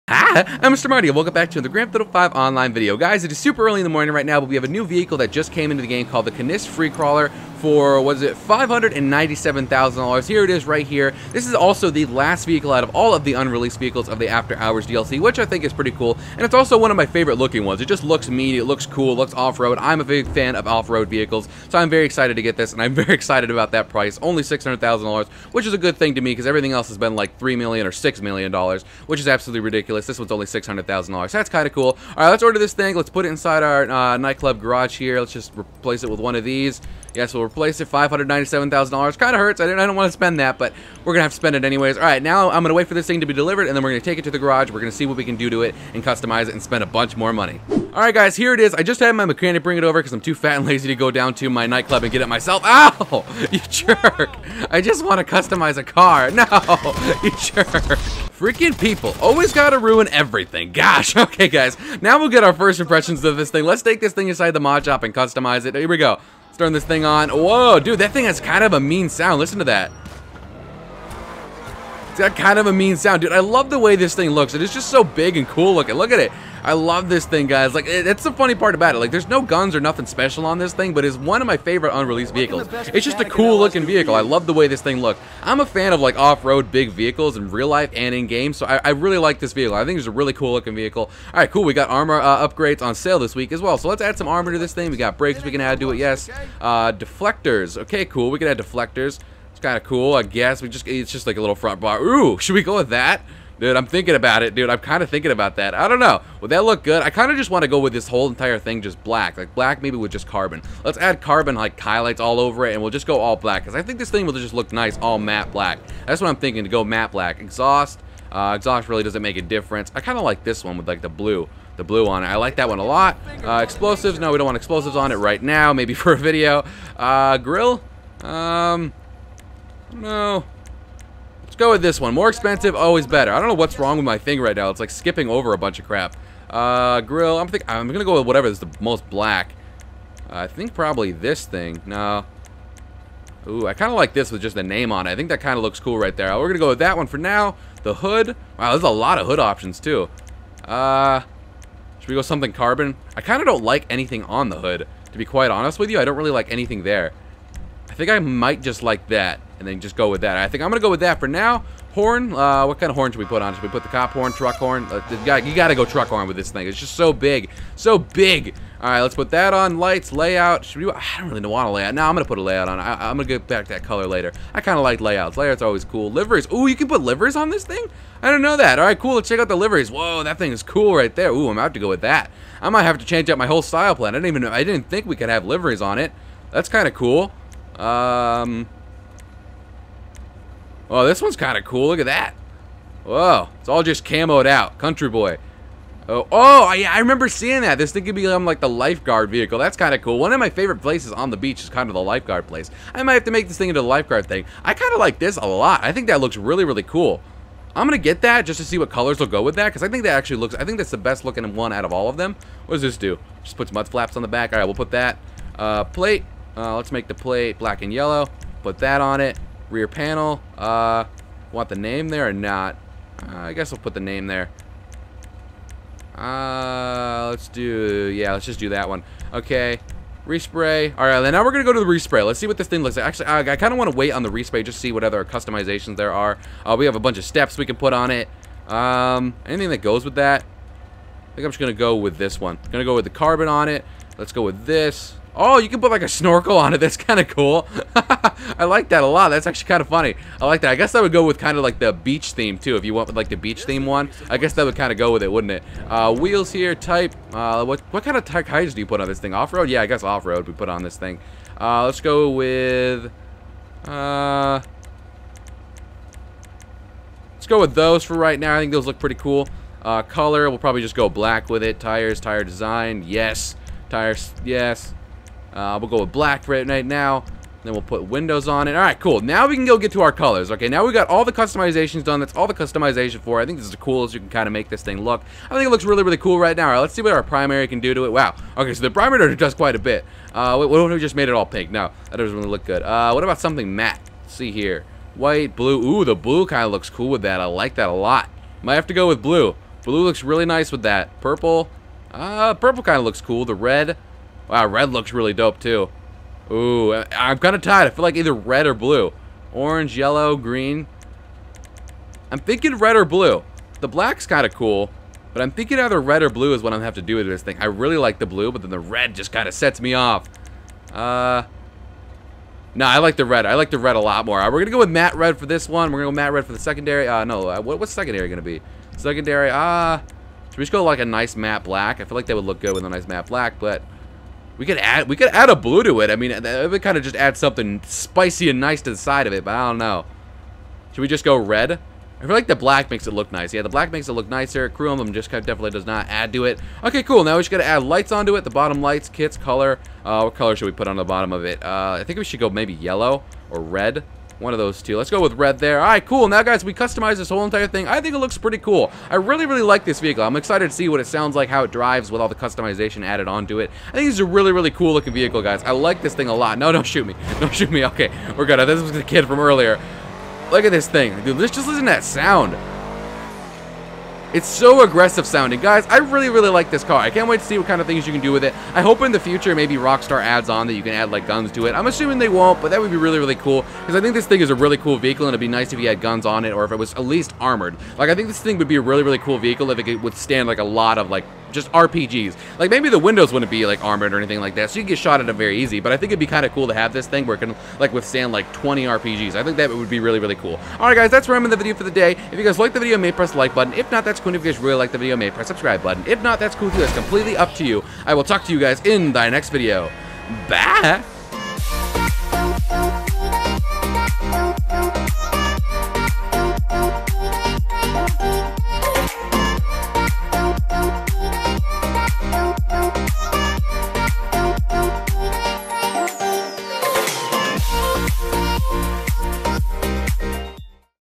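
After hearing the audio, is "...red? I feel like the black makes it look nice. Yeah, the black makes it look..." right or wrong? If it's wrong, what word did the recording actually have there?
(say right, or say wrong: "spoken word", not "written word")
right.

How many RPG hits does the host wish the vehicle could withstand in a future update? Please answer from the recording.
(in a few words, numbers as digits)
20.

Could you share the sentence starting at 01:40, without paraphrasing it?
We just it's just like a little front bar.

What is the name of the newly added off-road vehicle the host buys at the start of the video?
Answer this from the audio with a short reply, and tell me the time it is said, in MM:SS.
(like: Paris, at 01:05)
Canis FreeCrawler, at 00:06.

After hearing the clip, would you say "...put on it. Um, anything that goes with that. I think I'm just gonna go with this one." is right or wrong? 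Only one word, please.
right.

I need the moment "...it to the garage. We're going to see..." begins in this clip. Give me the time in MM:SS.
00:44.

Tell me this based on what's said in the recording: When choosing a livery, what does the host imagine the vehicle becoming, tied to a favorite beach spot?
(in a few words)
lifeguard vehicle.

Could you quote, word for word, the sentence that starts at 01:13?
Dude, I love the way this thing looks.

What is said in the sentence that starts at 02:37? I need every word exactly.
I think I might just like that and then just go with that.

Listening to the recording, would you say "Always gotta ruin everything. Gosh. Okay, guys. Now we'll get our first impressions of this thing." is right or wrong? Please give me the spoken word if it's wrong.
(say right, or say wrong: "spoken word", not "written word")
right.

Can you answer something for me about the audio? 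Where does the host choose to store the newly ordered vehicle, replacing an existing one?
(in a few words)
nightclub garage.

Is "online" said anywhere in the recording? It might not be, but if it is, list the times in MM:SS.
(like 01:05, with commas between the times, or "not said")
00:02.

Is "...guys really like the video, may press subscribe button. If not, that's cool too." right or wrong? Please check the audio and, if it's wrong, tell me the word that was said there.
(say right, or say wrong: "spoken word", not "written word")
right.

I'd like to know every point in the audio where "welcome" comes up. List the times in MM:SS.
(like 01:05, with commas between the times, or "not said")
00:01.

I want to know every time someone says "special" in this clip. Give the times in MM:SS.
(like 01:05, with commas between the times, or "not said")
01:20.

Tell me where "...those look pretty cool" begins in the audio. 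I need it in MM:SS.
04:28.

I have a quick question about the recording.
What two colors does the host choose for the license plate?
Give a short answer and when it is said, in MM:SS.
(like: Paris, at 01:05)
black and yellow, at 03:37.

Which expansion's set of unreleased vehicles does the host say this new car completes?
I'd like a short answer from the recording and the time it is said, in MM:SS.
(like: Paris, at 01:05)
After Hours, at 00:14.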